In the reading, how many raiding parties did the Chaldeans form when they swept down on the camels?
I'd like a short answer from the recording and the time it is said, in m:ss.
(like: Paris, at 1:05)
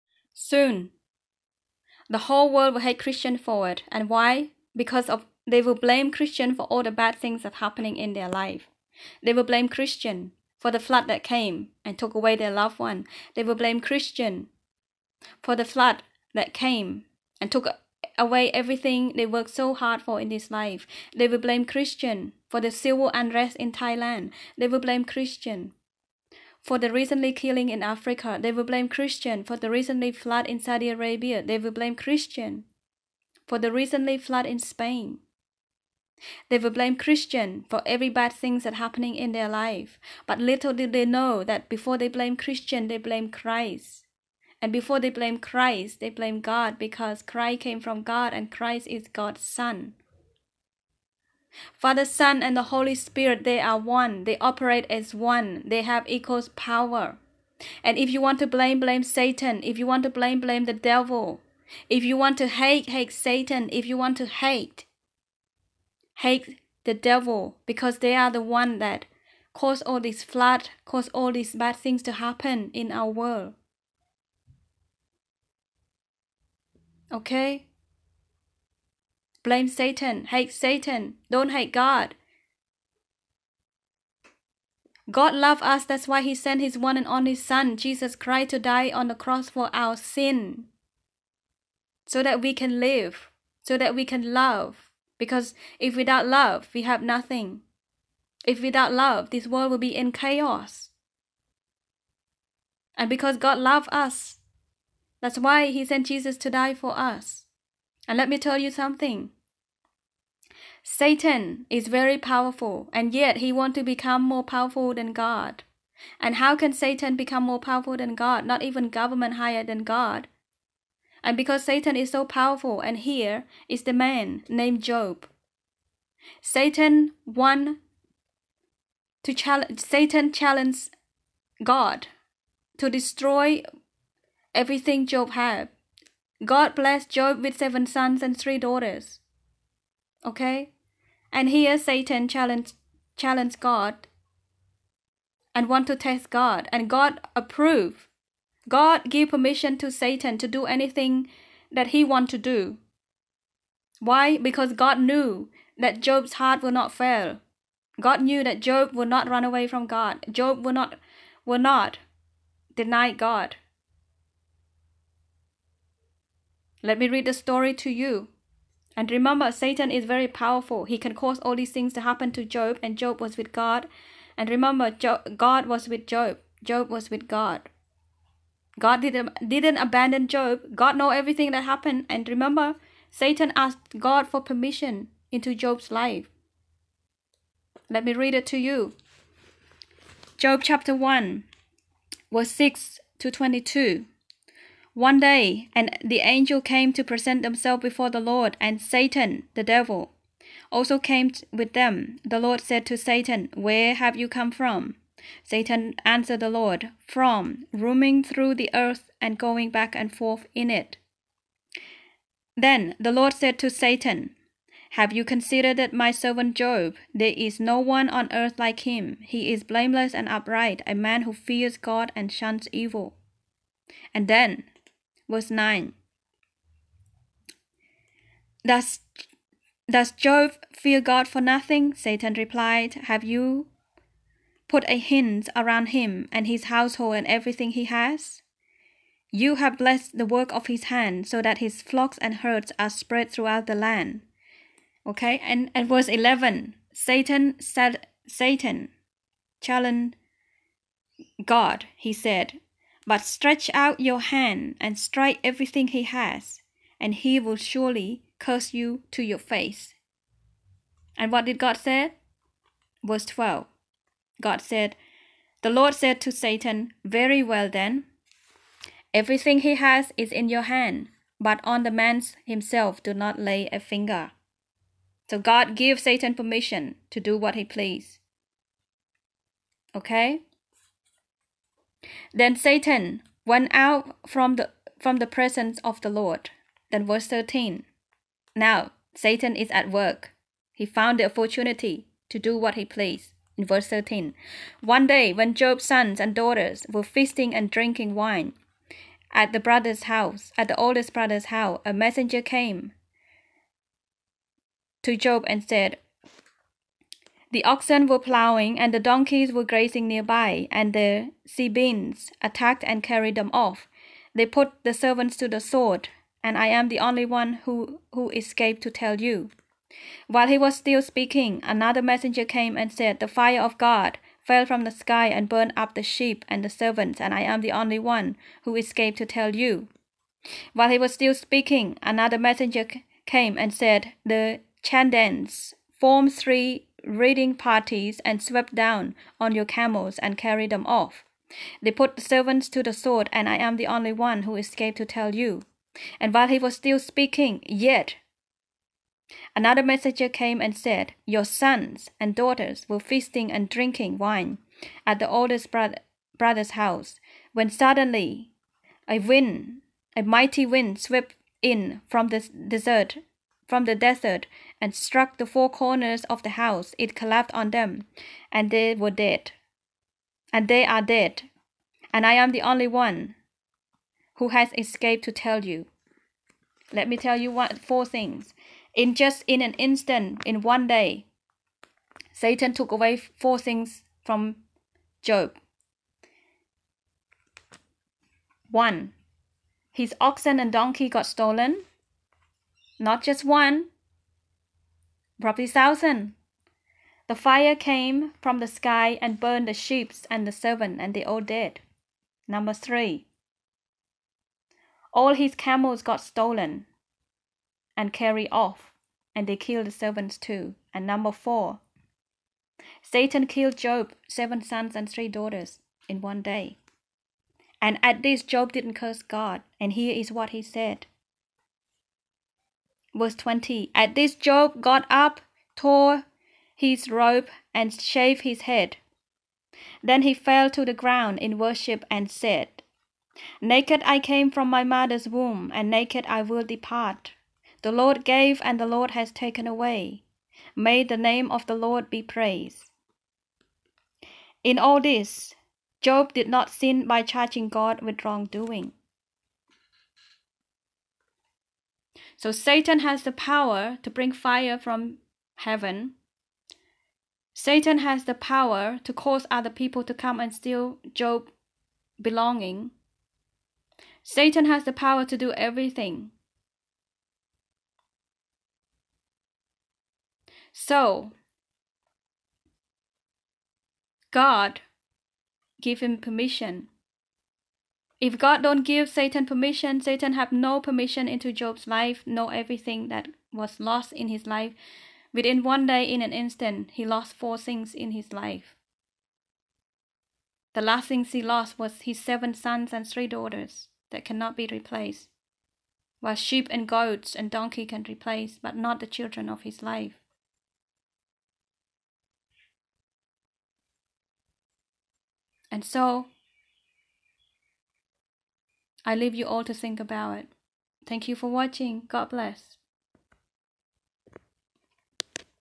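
3, at 5:36.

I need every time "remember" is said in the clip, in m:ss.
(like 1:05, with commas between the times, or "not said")
2:49, 2:54, 3:02.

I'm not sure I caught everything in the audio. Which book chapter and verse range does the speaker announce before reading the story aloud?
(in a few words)
Job 1:6-22.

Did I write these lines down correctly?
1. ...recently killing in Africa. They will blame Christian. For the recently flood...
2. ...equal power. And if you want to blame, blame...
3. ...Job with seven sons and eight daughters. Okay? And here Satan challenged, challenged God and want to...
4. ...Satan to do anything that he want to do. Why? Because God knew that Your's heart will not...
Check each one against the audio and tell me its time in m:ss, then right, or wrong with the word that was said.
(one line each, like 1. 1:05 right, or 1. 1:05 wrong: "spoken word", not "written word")
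1. 0:26 right
2. 0:56 right
3. 2:17 wrong: "three", not "eight"
4. 2:29 wrong: "Job", not "Your".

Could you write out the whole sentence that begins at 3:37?
There is no one on earth like him.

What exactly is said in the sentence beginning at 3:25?
Satan answered the Lord, From roaming through the earth and going back and forth in it.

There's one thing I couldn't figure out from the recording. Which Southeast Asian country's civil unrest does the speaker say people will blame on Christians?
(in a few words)
Thailand.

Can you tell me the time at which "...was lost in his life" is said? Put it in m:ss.
8:03.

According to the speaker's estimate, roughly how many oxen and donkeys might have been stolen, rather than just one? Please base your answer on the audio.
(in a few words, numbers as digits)
thousand.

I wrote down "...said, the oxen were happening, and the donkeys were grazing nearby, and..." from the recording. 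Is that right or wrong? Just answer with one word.
wrong.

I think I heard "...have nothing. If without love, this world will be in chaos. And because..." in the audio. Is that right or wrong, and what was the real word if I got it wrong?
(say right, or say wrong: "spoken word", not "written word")
right.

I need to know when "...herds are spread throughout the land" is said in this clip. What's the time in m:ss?
4:02.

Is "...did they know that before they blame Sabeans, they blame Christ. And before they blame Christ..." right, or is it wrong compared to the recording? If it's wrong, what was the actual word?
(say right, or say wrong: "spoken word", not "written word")
wrong: "Christian", not "Sabeans".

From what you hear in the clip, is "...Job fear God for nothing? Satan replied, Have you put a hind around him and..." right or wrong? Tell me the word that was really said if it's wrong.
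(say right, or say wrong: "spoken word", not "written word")
right.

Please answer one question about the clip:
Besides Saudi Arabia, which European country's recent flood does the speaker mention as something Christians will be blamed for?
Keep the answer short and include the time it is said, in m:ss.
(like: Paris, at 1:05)
Spain, at 0:34.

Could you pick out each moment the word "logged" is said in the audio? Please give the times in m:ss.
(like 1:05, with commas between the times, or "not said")
not said.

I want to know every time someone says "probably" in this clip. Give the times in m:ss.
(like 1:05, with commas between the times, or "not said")
6:35.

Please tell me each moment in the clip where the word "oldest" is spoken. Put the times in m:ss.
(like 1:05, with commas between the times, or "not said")
5:00, 5:55.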